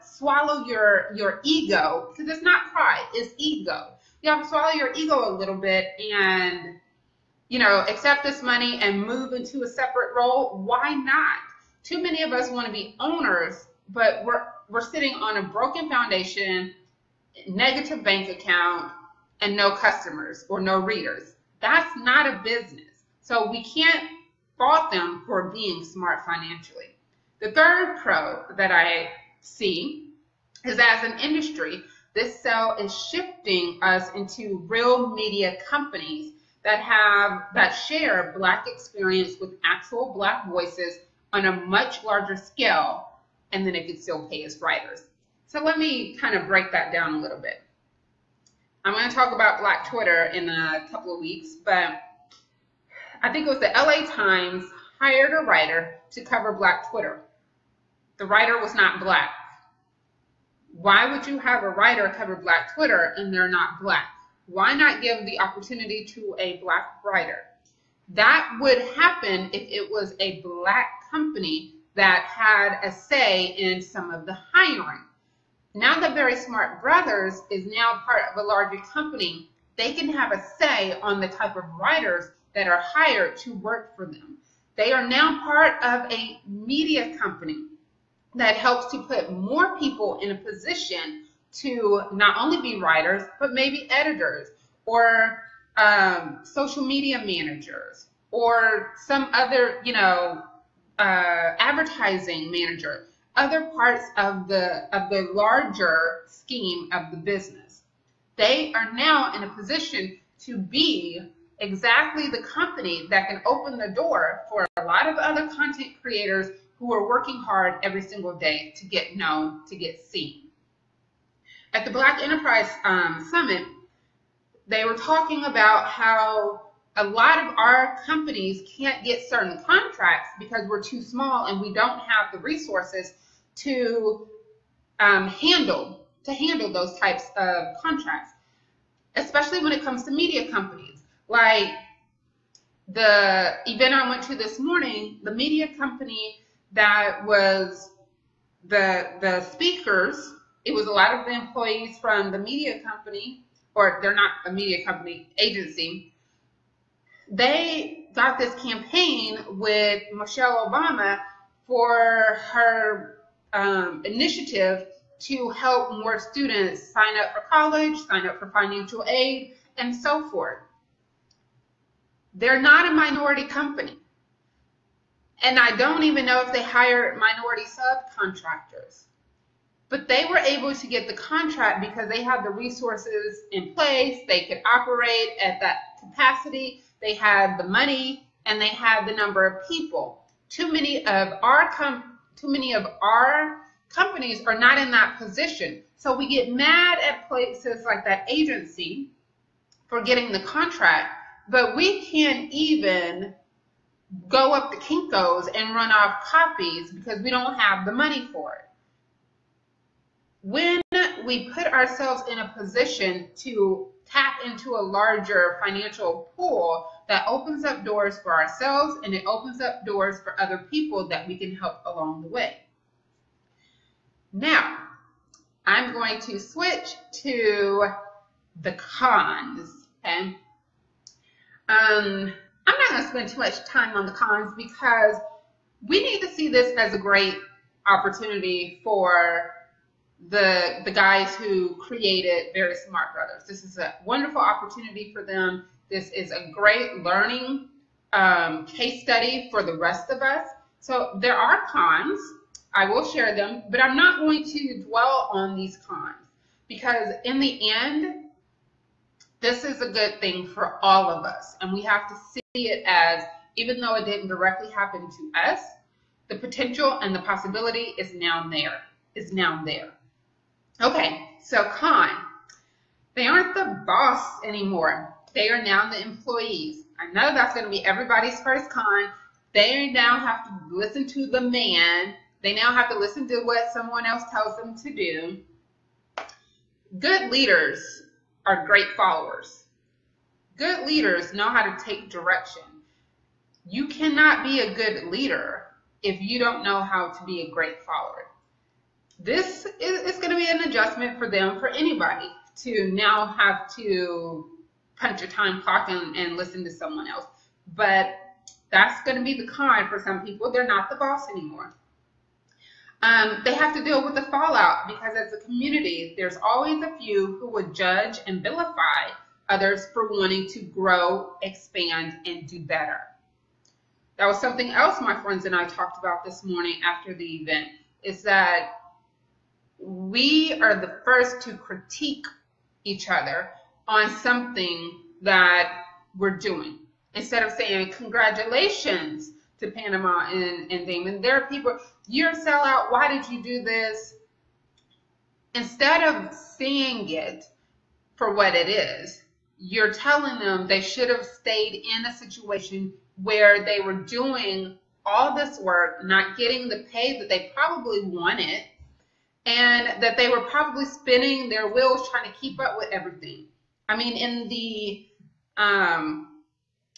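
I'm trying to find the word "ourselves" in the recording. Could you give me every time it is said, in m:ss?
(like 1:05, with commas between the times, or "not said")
3:31, 3:38.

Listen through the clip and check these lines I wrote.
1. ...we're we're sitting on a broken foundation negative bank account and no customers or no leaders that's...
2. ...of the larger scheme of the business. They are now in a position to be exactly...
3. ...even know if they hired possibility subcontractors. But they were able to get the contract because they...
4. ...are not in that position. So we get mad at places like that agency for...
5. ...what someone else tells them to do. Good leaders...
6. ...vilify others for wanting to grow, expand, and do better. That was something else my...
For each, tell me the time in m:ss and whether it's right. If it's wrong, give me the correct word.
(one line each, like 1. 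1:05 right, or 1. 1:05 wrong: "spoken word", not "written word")
1. 0:14 wrong: "readers", not "leaders"
2. 1:44 right
3. 2:56 wrong: "minority", not "possibility"
4. 3:14 right
5. 4:43 right
6. 5:18 right.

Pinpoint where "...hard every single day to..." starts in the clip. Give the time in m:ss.
1:57.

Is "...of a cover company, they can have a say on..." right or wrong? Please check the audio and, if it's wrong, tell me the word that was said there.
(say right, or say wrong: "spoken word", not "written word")
wrong: "larger", not "cover".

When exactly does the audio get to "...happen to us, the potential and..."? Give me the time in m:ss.
4:24.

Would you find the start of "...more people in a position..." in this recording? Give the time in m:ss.
1:29.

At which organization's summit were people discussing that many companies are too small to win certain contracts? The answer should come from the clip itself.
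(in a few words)
Black Enterprise.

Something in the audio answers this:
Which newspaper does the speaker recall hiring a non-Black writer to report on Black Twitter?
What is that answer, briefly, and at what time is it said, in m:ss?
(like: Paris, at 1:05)
LA Times, at 0:53.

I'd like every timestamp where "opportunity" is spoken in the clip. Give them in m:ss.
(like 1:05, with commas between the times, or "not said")
1:05, 3:57, 4:04.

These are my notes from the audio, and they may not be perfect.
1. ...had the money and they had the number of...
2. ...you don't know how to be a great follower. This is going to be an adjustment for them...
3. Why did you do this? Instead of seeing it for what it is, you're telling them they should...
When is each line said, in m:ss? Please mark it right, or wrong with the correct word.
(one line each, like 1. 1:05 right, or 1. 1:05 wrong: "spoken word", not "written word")
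1. 3:07 right
2. 4:56 right
3. 5:42 right.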